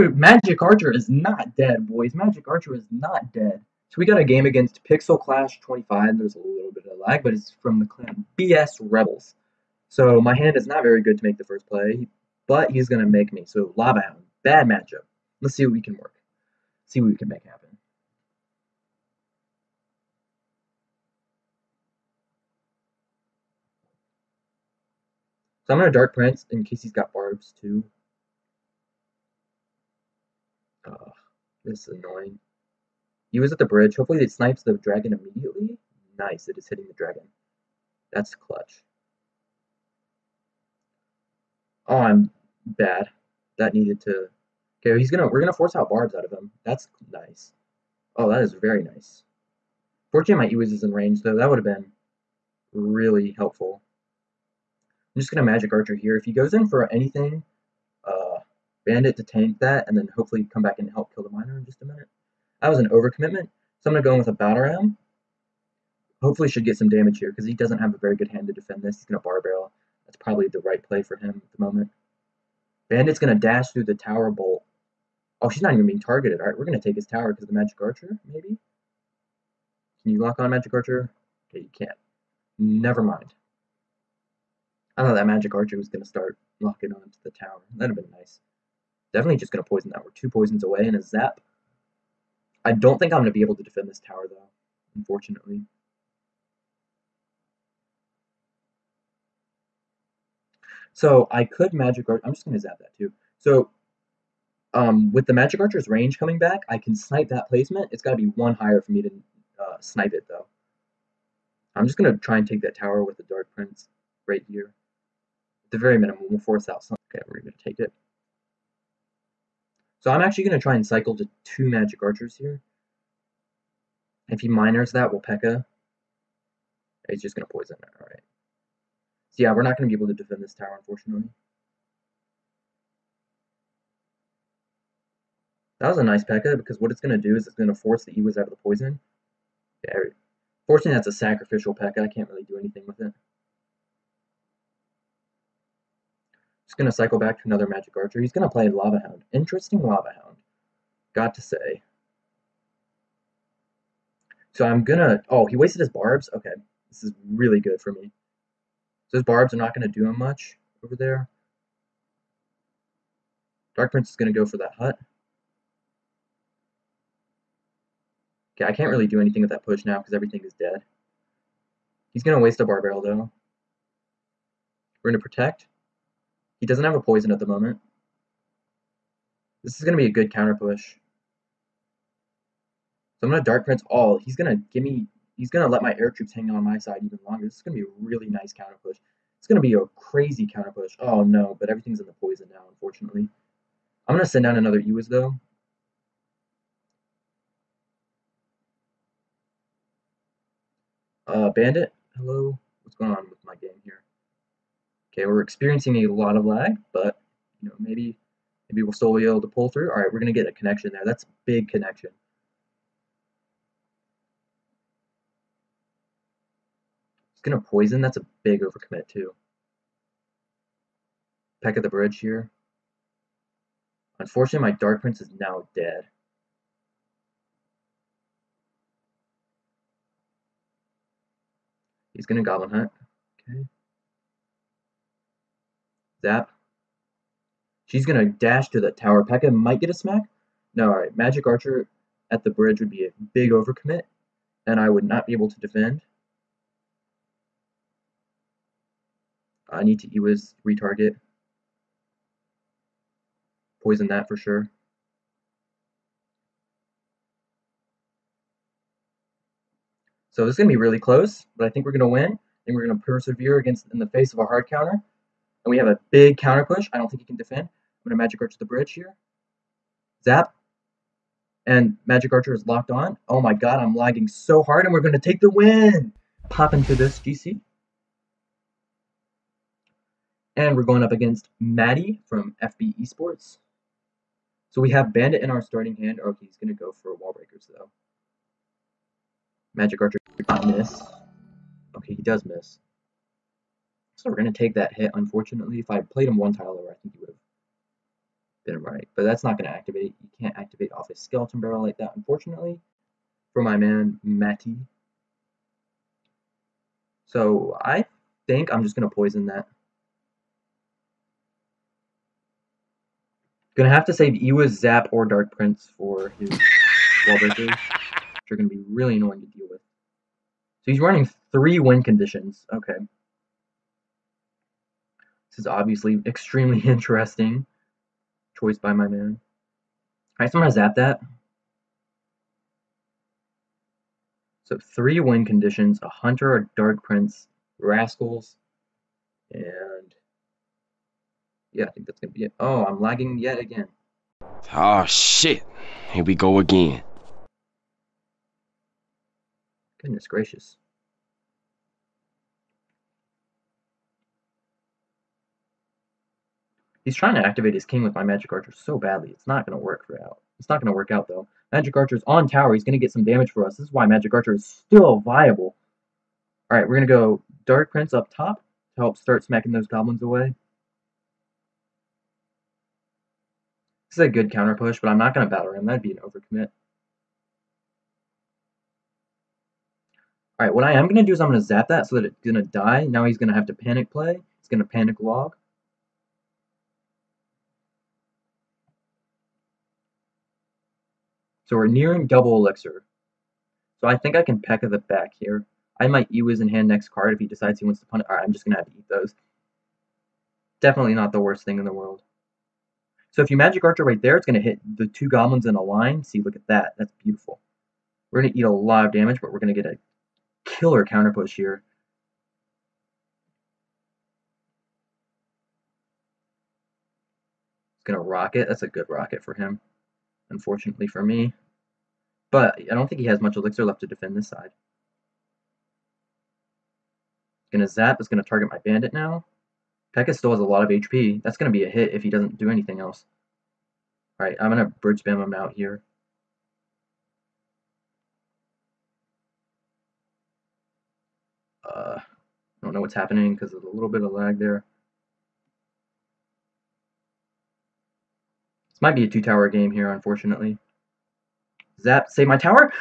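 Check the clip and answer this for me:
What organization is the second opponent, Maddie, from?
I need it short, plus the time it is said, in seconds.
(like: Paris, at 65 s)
FB Esports, at 282 s.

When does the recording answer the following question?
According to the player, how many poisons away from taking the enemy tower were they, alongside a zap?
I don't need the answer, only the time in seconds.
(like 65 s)
90 s.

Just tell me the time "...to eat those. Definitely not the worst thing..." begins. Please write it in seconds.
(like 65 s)
398 s.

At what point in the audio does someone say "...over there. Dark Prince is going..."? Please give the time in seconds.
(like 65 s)
160 s.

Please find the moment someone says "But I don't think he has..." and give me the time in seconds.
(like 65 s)
422 s.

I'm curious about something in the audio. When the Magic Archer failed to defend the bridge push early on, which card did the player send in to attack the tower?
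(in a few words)
Battle Ram.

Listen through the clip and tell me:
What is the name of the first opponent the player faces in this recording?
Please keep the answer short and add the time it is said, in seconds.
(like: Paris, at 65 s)
Pixel Clash 25, at 4 s.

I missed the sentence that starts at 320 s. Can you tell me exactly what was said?
So he's running three win conditions.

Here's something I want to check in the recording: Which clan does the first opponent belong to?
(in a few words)
BS Rebels.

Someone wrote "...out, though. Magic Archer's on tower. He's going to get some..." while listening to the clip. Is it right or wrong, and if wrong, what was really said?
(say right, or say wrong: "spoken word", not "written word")
right.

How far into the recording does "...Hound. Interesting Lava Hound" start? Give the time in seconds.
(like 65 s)
149 s.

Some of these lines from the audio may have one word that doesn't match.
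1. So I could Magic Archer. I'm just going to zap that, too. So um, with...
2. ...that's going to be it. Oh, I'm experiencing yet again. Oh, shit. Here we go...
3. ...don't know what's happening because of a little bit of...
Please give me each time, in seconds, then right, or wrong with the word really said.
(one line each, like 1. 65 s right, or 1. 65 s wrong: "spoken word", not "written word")
1. 100 s right
2. 342 s wrong: "lagging", not "experiencing"
3. 442 s right.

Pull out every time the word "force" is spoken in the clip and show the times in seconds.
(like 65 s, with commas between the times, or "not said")
45 s, 116 s, 137 s.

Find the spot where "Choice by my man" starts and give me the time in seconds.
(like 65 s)
328 s.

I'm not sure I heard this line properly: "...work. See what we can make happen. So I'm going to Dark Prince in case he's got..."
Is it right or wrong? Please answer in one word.
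right.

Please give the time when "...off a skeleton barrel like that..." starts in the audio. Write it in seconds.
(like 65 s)
300 s.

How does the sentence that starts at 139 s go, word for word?
Yeah, fortunately, that's a sacrificial P.E.K.K.A.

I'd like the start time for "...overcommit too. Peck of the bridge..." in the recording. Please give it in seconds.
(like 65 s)
218 s.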